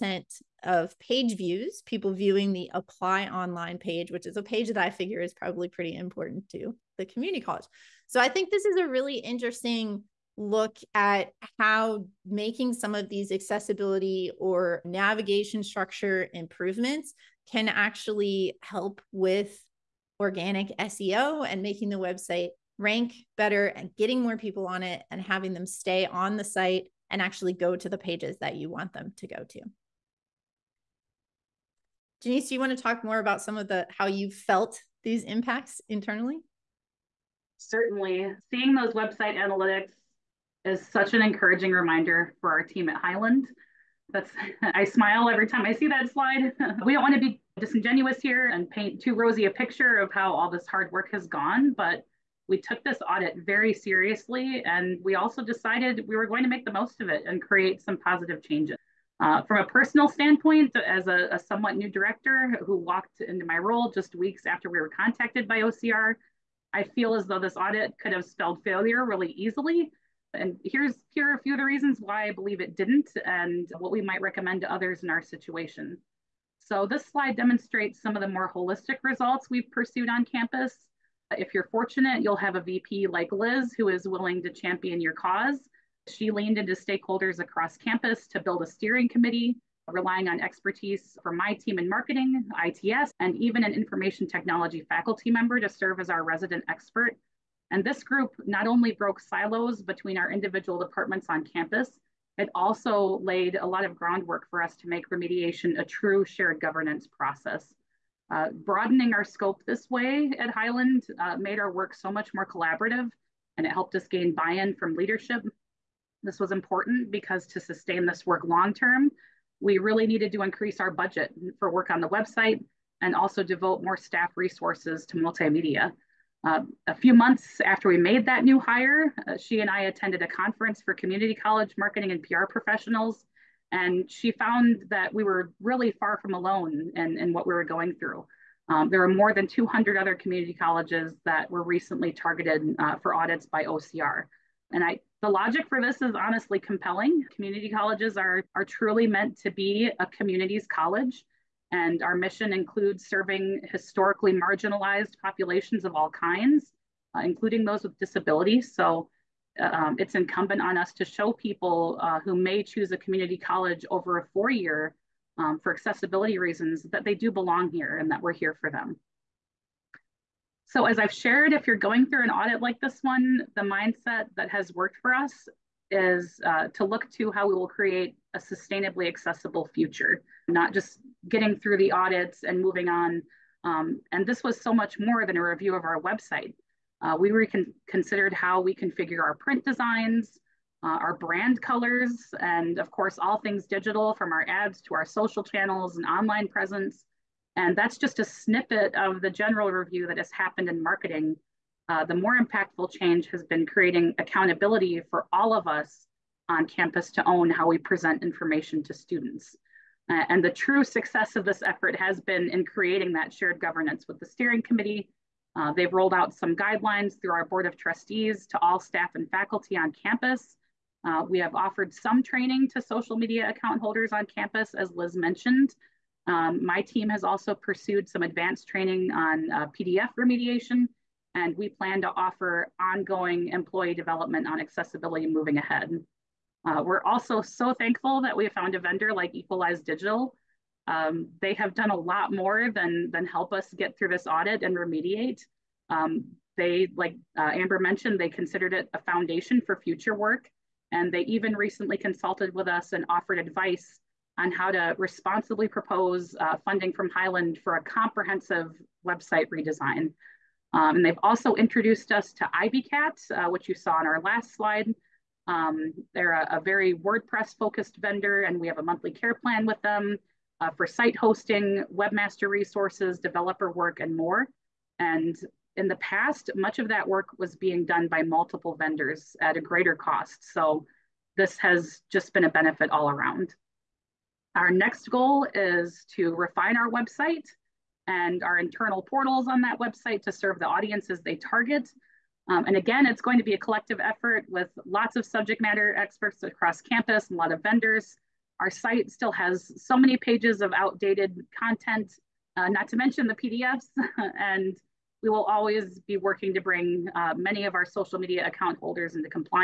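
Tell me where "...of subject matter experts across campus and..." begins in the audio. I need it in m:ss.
4:55.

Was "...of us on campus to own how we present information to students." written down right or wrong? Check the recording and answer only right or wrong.
right.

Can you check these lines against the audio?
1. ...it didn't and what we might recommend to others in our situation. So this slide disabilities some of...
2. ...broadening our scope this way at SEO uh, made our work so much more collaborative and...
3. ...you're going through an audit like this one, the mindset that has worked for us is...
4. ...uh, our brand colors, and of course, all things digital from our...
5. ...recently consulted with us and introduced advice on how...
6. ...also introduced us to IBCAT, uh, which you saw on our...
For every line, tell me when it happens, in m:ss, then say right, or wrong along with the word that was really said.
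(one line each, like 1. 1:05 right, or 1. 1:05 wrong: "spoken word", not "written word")
1. 1:12 wrong: "demonstrates", not "disabilities"
2. 1:48 wrong: "Highland", not "SEO"
3. 2:51 right
4. 3:10 right
5. 4:11 wrong: "offered", not "introduced"
6. 4:21 right.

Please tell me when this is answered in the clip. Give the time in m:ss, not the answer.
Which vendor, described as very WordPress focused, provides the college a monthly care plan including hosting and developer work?
3:59.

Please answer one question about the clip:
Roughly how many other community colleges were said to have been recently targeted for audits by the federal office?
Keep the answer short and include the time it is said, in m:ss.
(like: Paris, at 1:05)
200, at 2:19.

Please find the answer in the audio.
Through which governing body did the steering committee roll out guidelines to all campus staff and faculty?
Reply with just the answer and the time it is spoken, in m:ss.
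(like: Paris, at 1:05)
board of trustees, at 3:37.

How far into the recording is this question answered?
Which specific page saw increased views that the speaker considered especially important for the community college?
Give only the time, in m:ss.
0:02.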